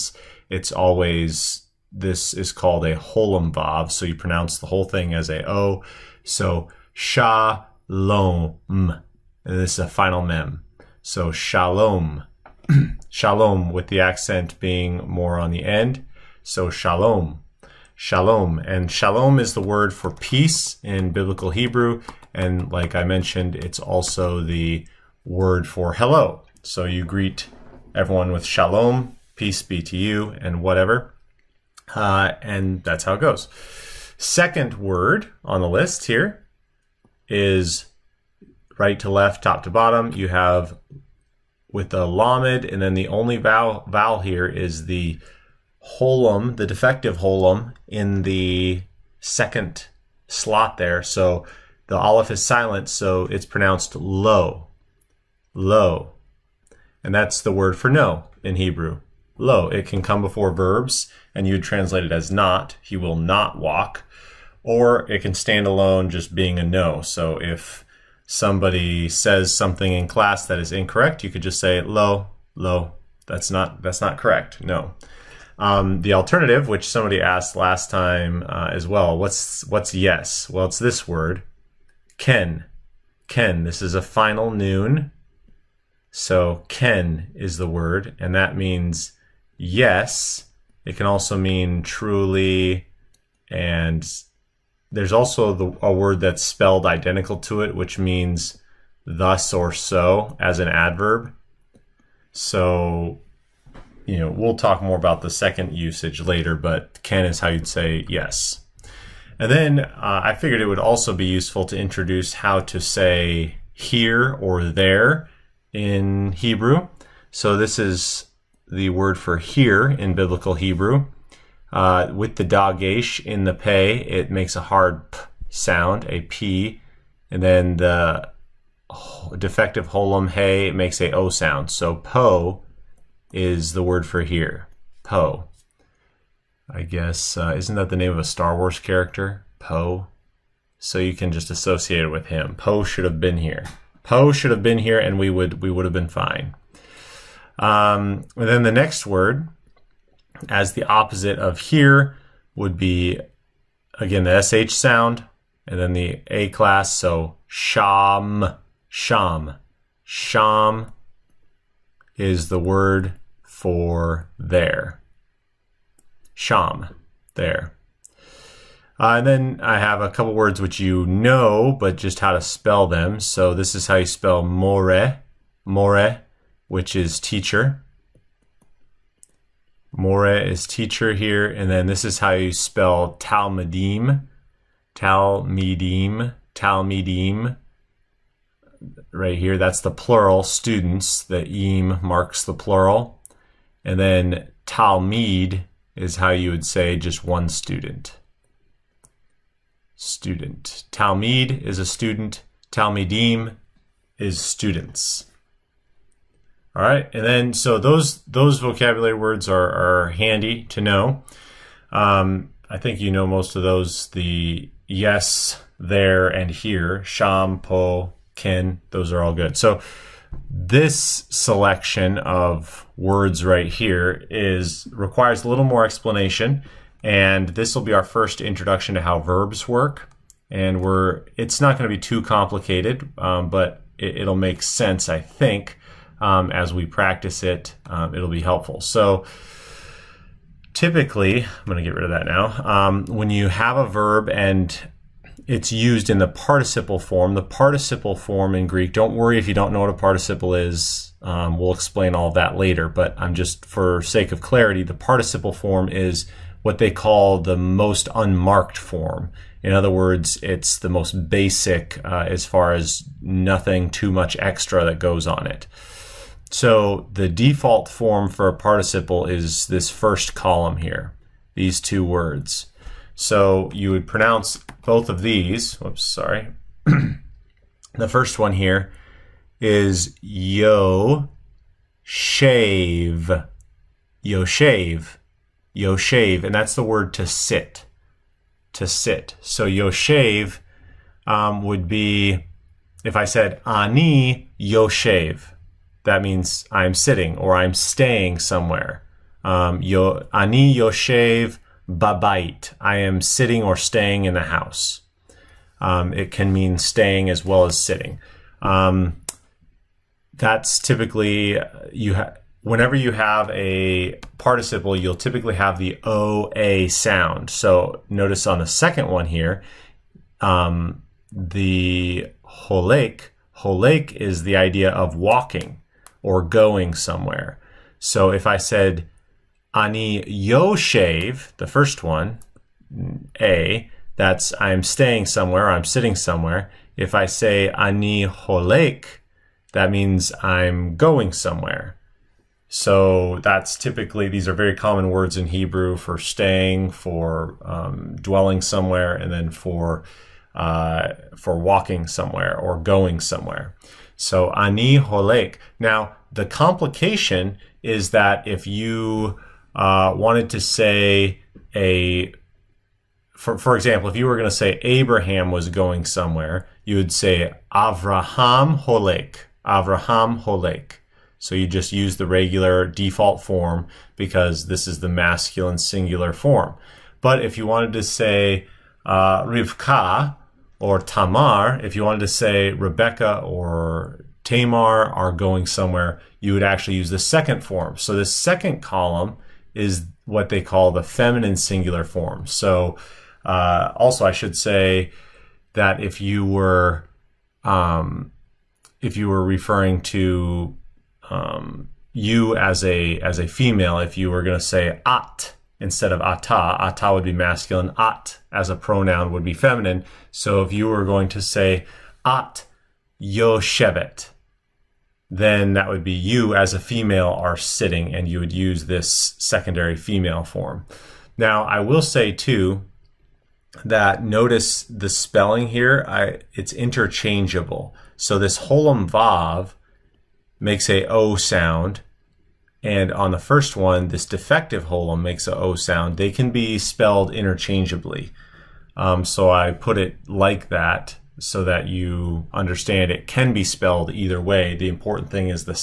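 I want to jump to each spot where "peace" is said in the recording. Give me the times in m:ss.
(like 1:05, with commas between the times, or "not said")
0:20, 0:29.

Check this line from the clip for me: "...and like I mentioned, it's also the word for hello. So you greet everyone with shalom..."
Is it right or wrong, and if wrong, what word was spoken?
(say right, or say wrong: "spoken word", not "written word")
right.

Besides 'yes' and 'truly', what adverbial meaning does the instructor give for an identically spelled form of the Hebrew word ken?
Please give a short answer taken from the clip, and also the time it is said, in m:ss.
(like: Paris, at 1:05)
thus or so, at 1:39.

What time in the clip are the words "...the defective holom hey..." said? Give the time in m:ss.
2:07.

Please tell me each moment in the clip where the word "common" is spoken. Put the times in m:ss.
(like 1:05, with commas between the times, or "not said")
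5:44.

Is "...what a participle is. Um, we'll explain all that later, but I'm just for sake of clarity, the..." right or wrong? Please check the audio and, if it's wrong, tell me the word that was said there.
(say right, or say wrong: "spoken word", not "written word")
right.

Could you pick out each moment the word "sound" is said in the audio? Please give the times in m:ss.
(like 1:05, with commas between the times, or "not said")
2:05, 2:11, 2:34, 5:16, 7:11, 7:15.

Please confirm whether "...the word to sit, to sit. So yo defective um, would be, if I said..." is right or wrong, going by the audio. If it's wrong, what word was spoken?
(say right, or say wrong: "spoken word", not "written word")
wrong: "shave", not "defective".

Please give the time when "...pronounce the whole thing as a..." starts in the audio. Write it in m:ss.
0:04.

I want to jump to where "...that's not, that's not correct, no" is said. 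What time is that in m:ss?
1:13.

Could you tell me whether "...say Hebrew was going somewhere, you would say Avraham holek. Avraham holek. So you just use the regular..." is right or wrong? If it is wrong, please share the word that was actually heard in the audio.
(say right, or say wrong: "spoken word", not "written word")
wrong: "Abraham", not "Hebrew".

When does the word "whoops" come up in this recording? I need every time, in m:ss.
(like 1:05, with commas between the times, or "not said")
4:35.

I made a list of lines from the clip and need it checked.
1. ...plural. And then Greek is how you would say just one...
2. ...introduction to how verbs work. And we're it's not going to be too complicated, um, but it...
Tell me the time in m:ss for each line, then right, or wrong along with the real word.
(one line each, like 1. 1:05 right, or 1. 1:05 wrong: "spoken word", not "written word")
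1. 3:12 wrong: "Talmud", not "Greek"
2. 3:48 right.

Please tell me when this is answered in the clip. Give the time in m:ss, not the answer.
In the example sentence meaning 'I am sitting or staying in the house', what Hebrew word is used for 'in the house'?
5:01.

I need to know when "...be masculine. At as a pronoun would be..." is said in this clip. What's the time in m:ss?
6:47.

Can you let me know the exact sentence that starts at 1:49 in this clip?
And then uh, I figured it would also be useful to introduce how to say here or there in Hebrew.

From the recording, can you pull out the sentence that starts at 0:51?
So the aleph is silent, so it's pronounced low, low.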